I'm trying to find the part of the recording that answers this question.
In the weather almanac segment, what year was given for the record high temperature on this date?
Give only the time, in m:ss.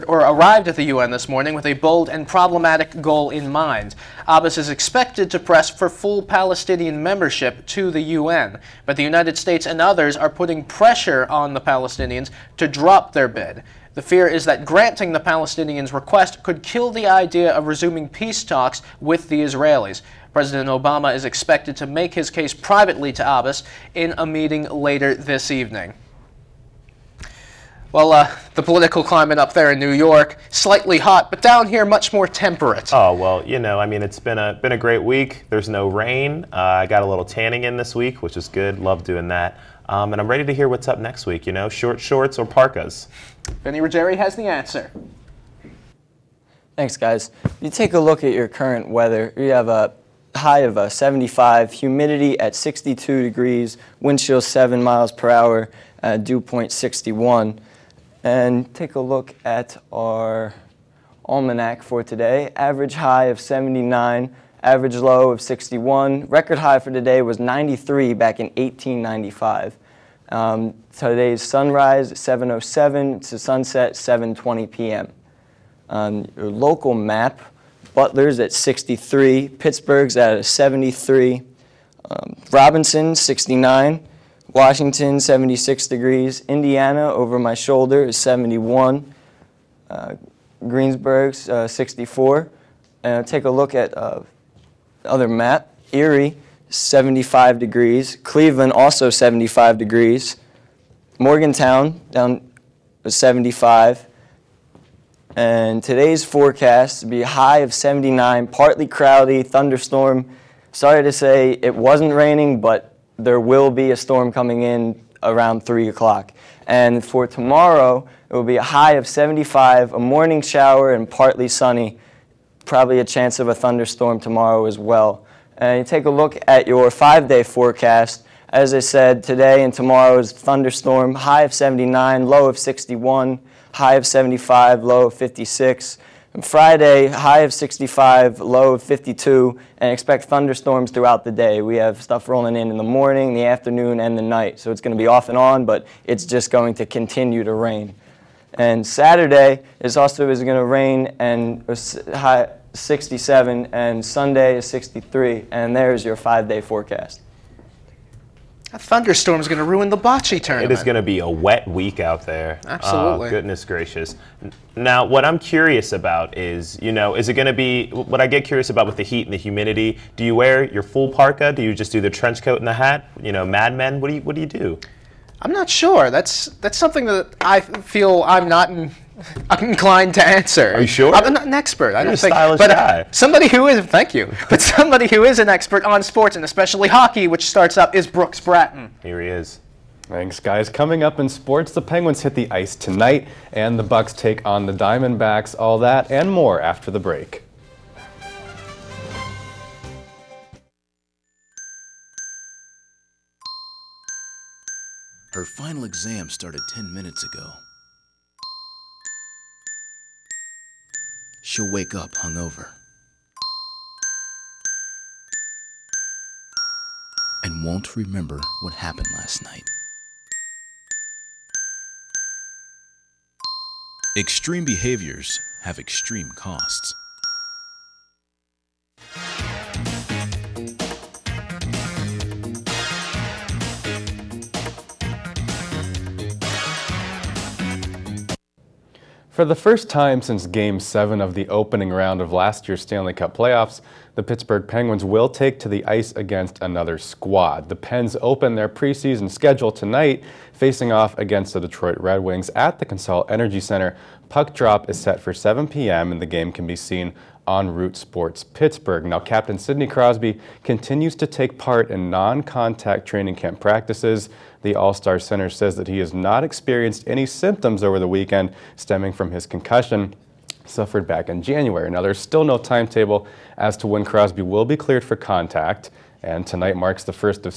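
1:08.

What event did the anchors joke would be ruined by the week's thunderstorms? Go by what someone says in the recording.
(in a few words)
bocce tournament.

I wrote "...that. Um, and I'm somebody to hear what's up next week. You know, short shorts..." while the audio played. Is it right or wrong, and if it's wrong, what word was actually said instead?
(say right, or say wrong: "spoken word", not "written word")
wrong: "ready", not "somebody".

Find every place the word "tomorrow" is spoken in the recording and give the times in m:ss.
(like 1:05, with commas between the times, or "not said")
1:57, 2:04, 2:09.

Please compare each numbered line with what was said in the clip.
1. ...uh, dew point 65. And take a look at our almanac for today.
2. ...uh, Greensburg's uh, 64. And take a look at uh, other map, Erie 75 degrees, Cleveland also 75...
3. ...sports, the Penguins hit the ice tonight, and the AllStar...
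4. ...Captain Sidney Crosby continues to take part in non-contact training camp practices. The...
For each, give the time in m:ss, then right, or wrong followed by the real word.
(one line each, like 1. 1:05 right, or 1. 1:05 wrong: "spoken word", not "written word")
1. 0:56 wrong: "61", not "65"
2. 1:29 right
3. 3:11 wrong: "Bucs", not "AllStar"
4. 4:19 right.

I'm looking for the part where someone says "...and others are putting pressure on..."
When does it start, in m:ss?
0:09.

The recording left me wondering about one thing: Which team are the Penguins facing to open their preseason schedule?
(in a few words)
Detroit Red Wings.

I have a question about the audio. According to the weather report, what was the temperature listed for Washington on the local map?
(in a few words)
76 degrees.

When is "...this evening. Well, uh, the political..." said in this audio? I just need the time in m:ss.
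0:25.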